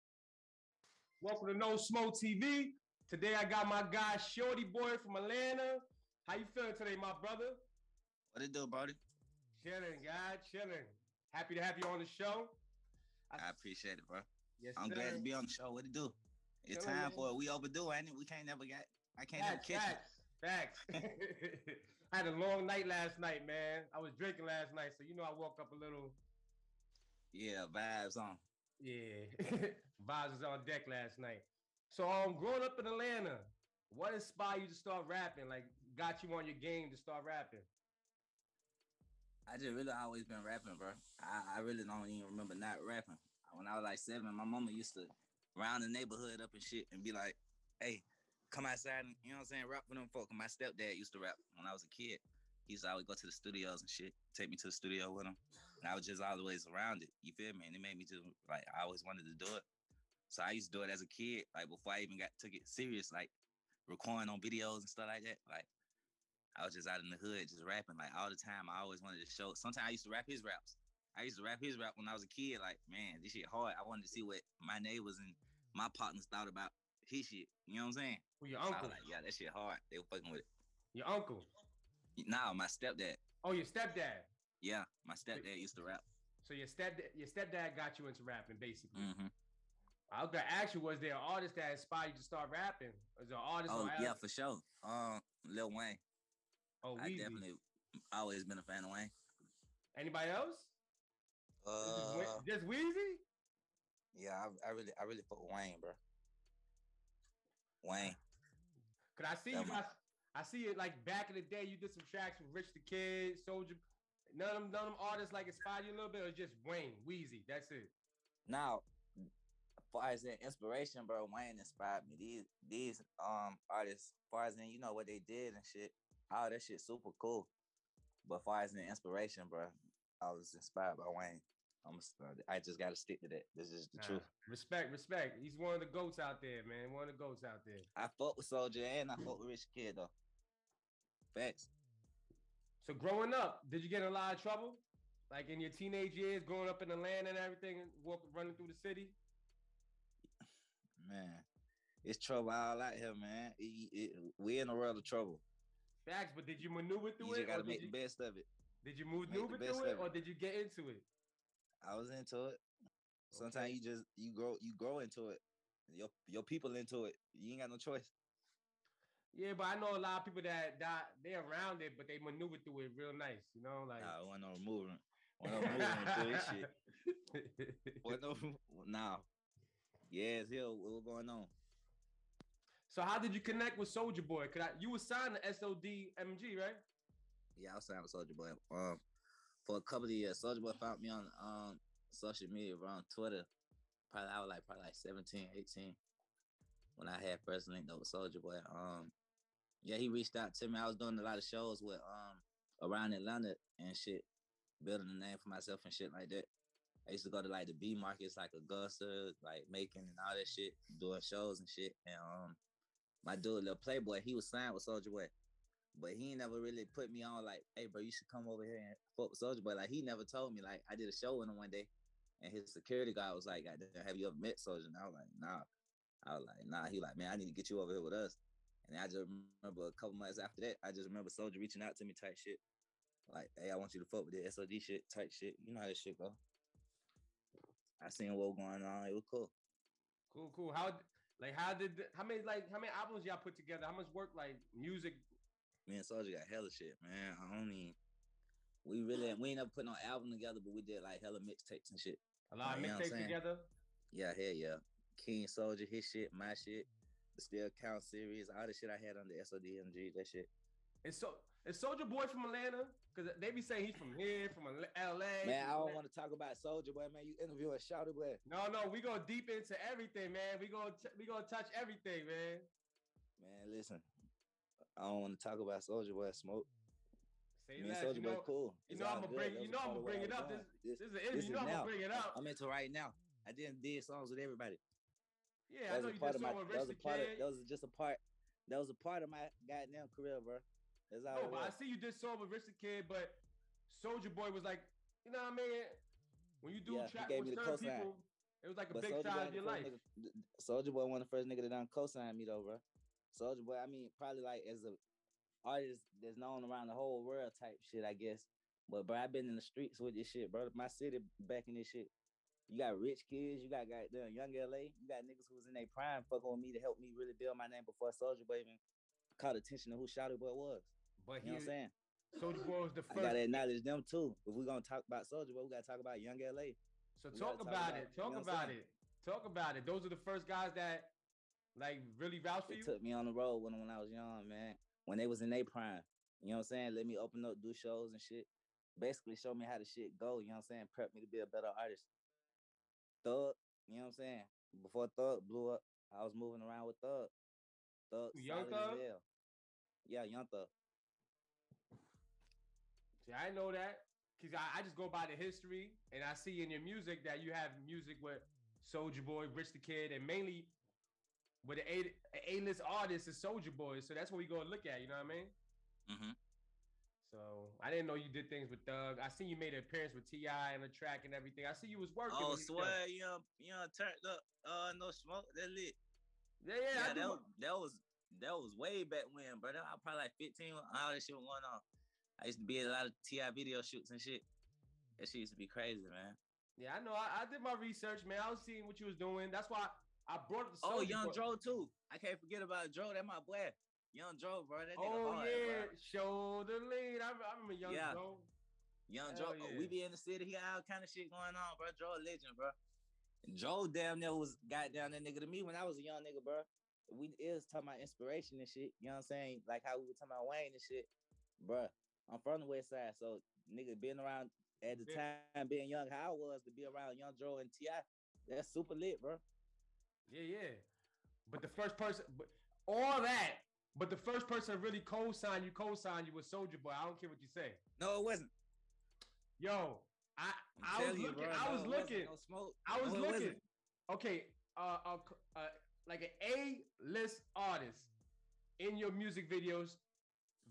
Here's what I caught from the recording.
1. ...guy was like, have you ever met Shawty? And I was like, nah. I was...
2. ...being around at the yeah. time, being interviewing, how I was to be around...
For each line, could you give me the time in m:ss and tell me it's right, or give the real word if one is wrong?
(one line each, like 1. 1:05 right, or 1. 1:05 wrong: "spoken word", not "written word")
1. 3:43 wrong: "Soulja", not "Shawty"
2. 6:53 wrong: "young", not "interviewing".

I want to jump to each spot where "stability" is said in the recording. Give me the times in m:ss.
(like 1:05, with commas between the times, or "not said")
not said.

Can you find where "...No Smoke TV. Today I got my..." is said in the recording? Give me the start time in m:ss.
0:01.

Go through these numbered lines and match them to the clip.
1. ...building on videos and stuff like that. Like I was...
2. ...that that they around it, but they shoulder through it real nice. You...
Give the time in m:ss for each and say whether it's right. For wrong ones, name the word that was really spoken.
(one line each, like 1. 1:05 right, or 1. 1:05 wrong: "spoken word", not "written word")
1. 1:03 wrong: "recording", not "building"
2. 2:50 wrong: "maneuver", not "shoulder".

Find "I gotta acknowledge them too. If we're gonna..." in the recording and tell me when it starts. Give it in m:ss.
5:23.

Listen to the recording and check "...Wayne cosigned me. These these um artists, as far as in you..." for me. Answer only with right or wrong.
wrong.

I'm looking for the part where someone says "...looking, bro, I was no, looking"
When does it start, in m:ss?
7:11.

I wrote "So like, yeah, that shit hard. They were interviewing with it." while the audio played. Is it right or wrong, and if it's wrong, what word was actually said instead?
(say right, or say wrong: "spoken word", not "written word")
wrong: "fucking", not "interviewing".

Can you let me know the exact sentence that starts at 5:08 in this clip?
But bro, I've been in the streets with this shit, bro.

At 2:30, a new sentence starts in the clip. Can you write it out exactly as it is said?
Man, it's trouble all out here, man.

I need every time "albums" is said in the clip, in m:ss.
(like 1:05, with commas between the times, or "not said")
4:02, 4:10.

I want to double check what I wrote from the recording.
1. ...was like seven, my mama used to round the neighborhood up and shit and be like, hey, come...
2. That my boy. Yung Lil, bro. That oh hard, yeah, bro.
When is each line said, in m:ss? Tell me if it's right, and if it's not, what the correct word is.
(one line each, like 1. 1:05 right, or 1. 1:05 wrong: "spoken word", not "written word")
1. 0:43 right
2. 6:33 wrong: "Joc", not "Lil".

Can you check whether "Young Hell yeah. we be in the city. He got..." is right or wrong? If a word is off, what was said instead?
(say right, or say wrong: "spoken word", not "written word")
right.